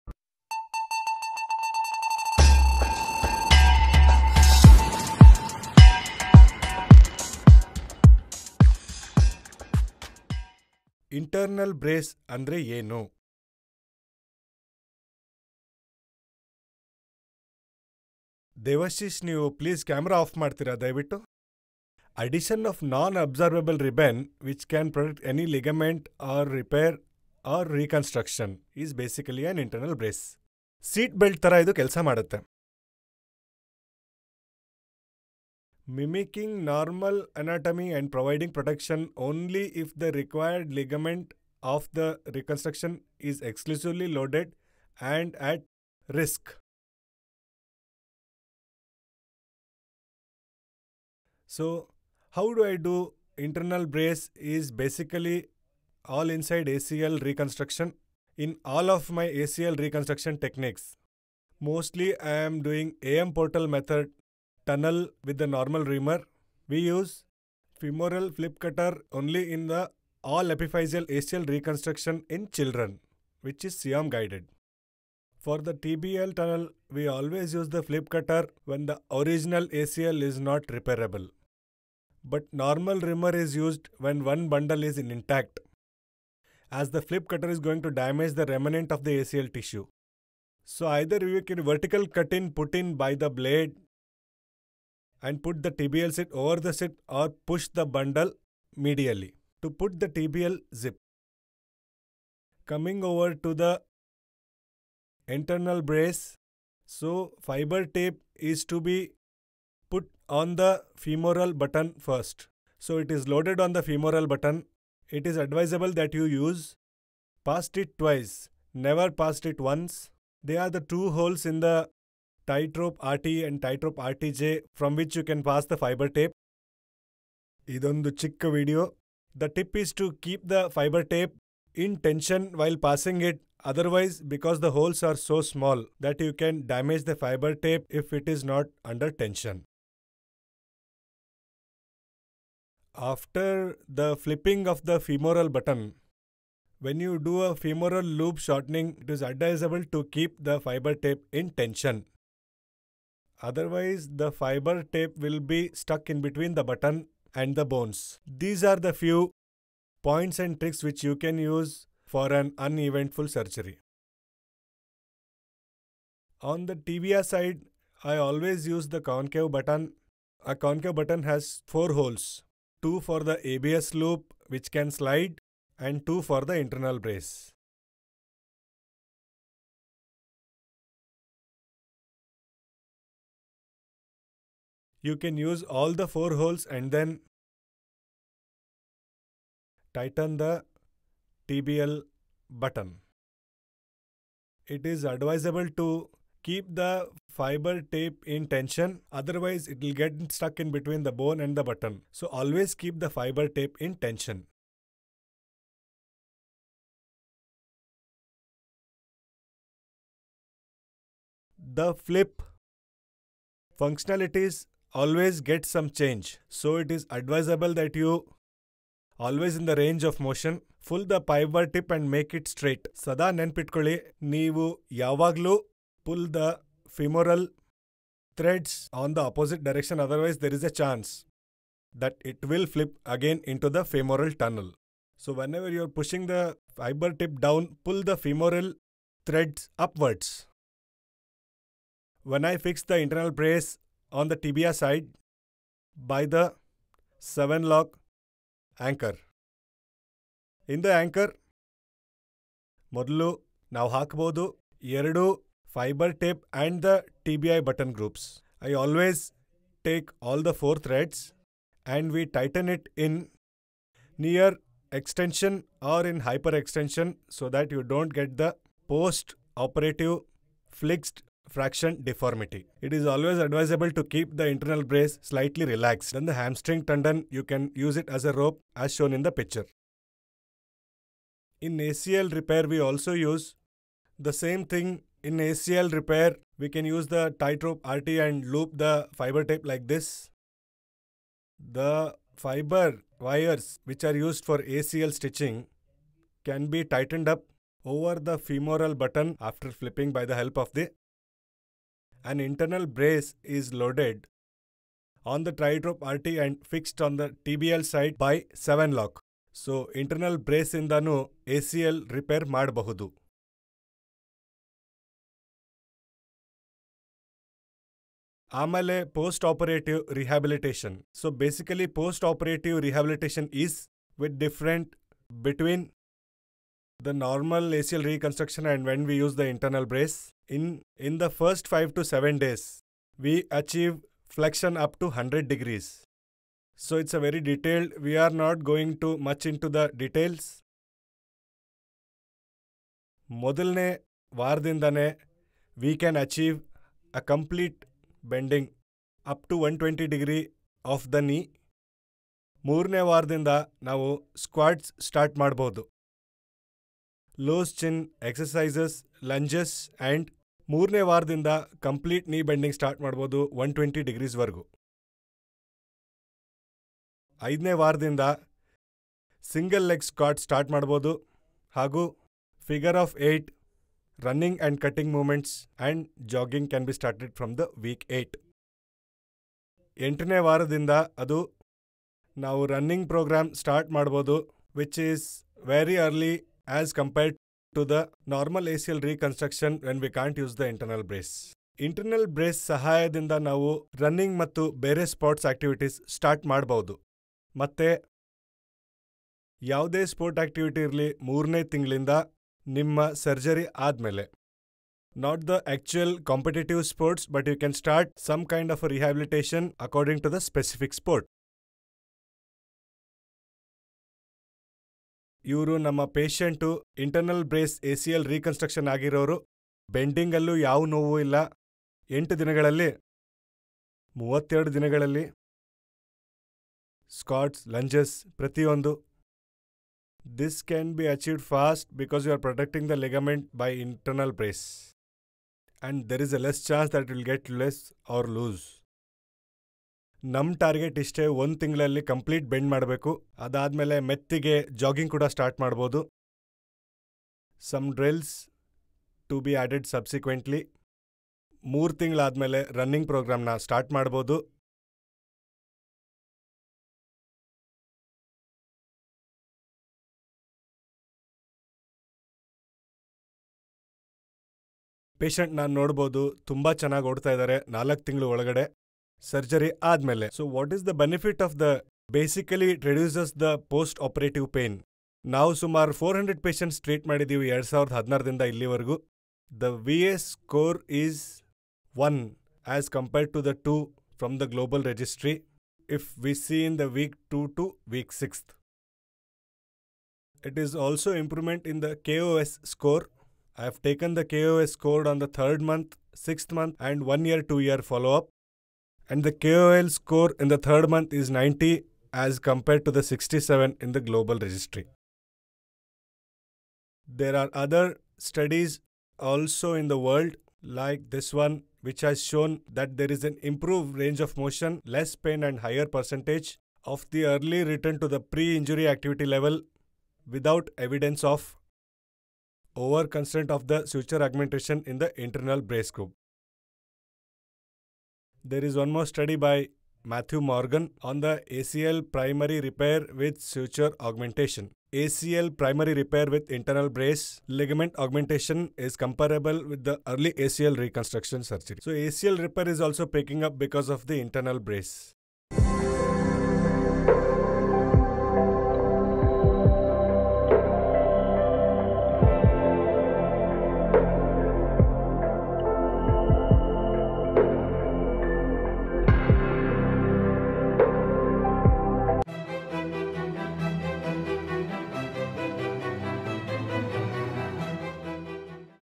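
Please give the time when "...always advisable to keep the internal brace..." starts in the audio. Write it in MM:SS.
04:33.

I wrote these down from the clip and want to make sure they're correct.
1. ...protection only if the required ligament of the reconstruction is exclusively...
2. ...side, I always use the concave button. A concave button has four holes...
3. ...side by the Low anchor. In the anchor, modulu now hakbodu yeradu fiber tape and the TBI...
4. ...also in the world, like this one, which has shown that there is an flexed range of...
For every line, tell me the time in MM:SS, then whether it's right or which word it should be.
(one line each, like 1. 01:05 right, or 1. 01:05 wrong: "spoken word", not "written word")
1. 00:38 right
2. 02:47 right
3. 04:04 wrong: "SwiveLock", not "Low"
4. 08:29 wrong: "improved", not "flexed".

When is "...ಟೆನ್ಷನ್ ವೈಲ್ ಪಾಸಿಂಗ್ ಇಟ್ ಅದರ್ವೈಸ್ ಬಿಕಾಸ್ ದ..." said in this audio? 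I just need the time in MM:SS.
02:12.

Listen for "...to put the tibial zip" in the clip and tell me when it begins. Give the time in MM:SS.
01:39.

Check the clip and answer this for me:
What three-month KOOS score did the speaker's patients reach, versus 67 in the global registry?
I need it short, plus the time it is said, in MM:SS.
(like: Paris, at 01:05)
90, at 08:21.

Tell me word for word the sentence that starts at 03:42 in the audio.
Sada nenpitkoli, neevu yavaglu, pull the femoral threads on the opposite direction.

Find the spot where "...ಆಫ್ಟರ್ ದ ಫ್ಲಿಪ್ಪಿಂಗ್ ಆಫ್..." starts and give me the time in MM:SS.
02:23.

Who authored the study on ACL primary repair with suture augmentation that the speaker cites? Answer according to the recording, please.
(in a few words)
Matthew Morgan.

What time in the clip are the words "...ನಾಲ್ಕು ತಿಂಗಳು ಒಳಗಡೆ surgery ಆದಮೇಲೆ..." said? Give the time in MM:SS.
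07:47.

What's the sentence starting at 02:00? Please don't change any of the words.
They are the two holes in the tightrope RT and tightrope RTJ from which you can pass the fiber tape.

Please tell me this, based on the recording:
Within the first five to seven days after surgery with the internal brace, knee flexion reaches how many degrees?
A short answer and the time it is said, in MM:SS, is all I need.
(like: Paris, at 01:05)
100, at 05:35.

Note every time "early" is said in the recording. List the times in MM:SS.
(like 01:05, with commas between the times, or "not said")
08:37, 09:00.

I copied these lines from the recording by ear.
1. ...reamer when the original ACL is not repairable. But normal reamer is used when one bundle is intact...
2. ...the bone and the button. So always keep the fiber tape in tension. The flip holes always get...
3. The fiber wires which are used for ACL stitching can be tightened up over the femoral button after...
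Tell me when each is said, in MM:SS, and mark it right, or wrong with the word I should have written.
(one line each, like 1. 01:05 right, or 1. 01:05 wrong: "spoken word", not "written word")
1. 01:18 wrong: "cutter", not "reamer"
2. 03:21 wrong: "functionalities", not "holes"
3. 04:51 right.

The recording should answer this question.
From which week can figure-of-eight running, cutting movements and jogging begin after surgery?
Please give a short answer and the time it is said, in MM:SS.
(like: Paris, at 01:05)
week 8, at 06:17.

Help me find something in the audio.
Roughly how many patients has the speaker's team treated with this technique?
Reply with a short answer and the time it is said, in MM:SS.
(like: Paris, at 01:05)
400, at 07:55.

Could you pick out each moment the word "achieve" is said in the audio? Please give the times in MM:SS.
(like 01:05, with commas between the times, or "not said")
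05:33, 05:46.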